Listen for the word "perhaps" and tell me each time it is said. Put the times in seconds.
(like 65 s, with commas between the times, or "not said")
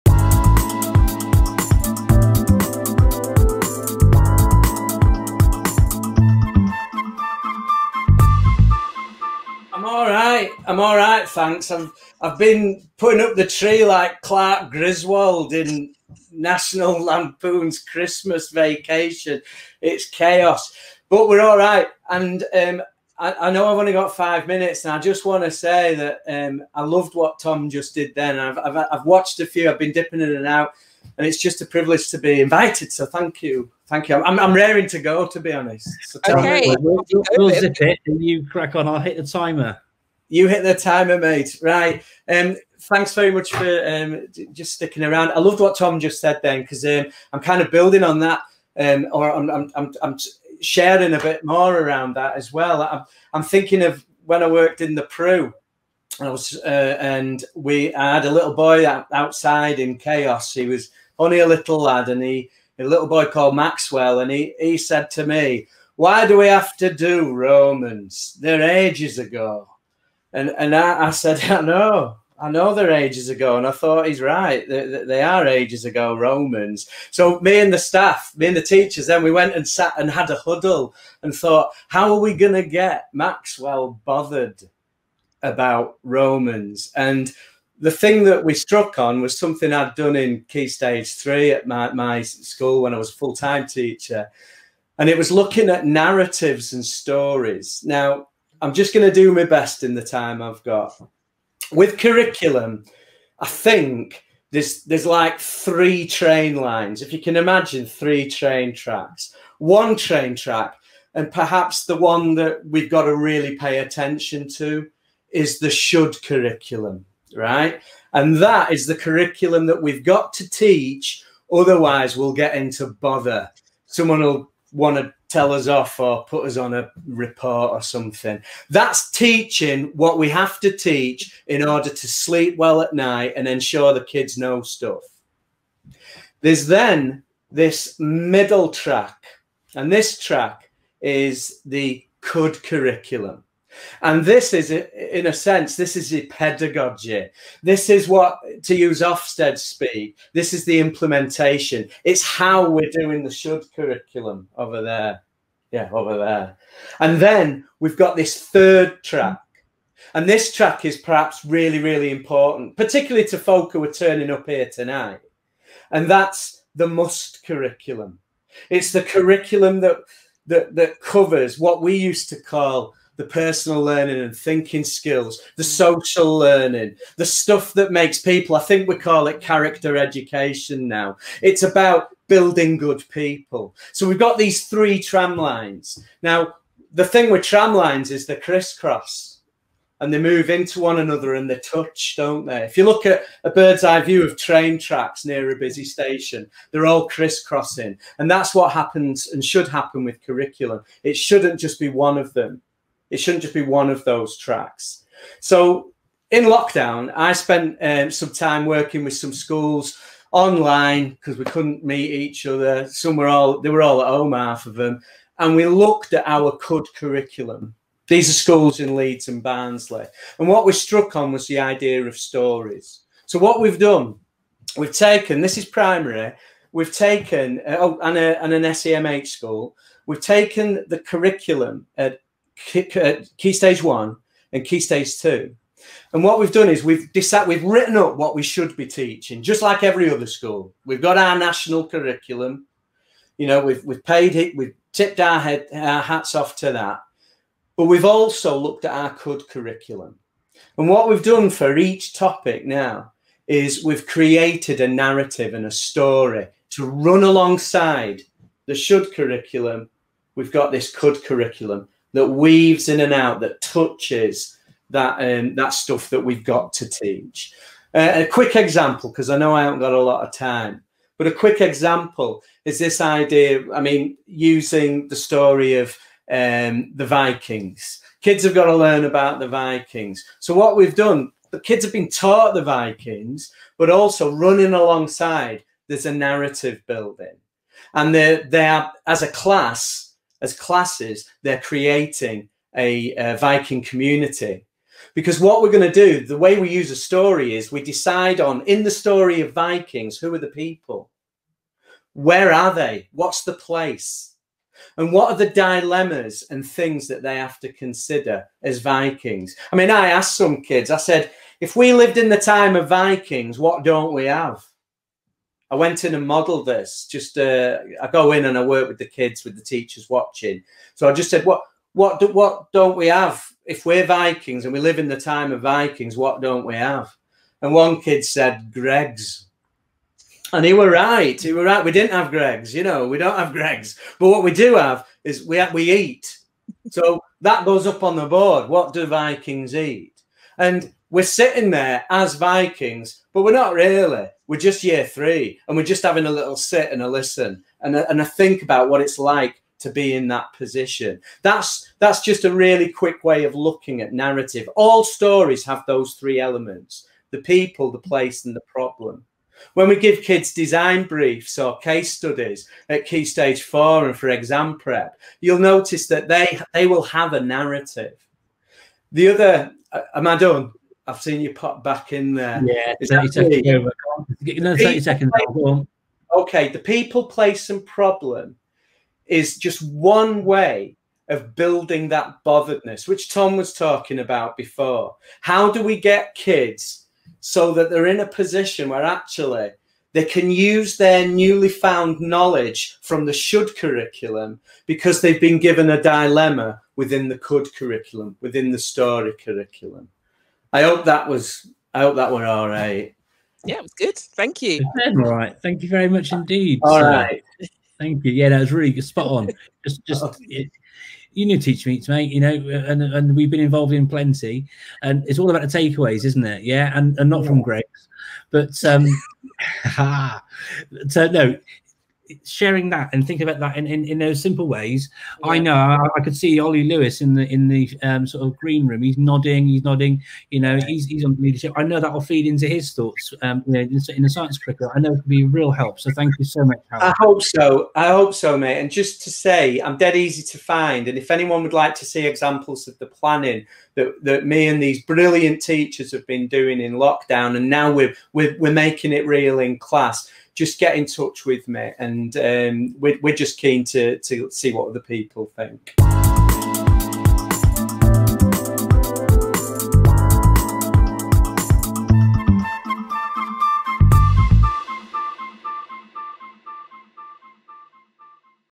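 111 s, 160 s.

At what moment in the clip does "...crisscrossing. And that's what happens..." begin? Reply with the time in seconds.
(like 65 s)
197 s.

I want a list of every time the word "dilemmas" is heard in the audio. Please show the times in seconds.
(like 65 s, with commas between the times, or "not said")
305 s, 396 s.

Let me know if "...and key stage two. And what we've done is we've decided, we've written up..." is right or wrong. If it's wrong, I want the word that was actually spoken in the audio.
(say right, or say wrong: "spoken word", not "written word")
right.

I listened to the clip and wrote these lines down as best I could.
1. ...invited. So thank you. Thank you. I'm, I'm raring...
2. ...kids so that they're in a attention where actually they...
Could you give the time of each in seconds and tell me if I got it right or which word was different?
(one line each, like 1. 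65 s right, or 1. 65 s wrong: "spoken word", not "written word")
1. 32 s right
2. 386 s wrong: "position", not "attention".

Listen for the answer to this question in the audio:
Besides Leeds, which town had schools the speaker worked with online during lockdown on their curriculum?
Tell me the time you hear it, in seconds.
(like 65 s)
219 s.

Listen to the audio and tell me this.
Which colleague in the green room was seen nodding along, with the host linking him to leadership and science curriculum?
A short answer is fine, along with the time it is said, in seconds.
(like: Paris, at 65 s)
Ollie Lewis, at 426 s.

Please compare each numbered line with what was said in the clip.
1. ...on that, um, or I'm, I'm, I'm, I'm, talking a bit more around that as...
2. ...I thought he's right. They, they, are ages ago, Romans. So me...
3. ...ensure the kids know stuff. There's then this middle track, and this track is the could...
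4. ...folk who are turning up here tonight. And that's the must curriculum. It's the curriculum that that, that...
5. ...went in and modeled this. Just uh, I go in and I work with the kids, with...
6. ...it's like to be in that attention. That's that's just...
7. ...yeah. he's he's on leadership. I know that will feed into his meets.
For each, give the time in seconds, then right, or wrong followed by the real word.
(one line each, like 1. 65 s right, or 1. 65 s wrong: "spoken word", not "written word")
1. 48 s wrong: "sharing", not "talking"
2. 73 s right
3. 133 s right
4. 163 s right
5. 315 s right
6. 349 s wrong: "position", not "attention"
7. 430 s wrong: "thoughts", not "meets".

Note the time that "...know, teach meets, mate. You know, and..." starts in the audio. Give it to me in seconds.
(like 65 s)
411 s.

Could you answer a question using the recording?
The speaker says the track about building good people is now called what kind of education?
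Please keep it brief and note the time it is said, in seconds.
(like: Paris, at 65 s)
character education, at 179 s.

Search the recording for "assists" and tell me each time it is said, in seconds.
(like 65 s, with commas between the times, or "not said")
not said.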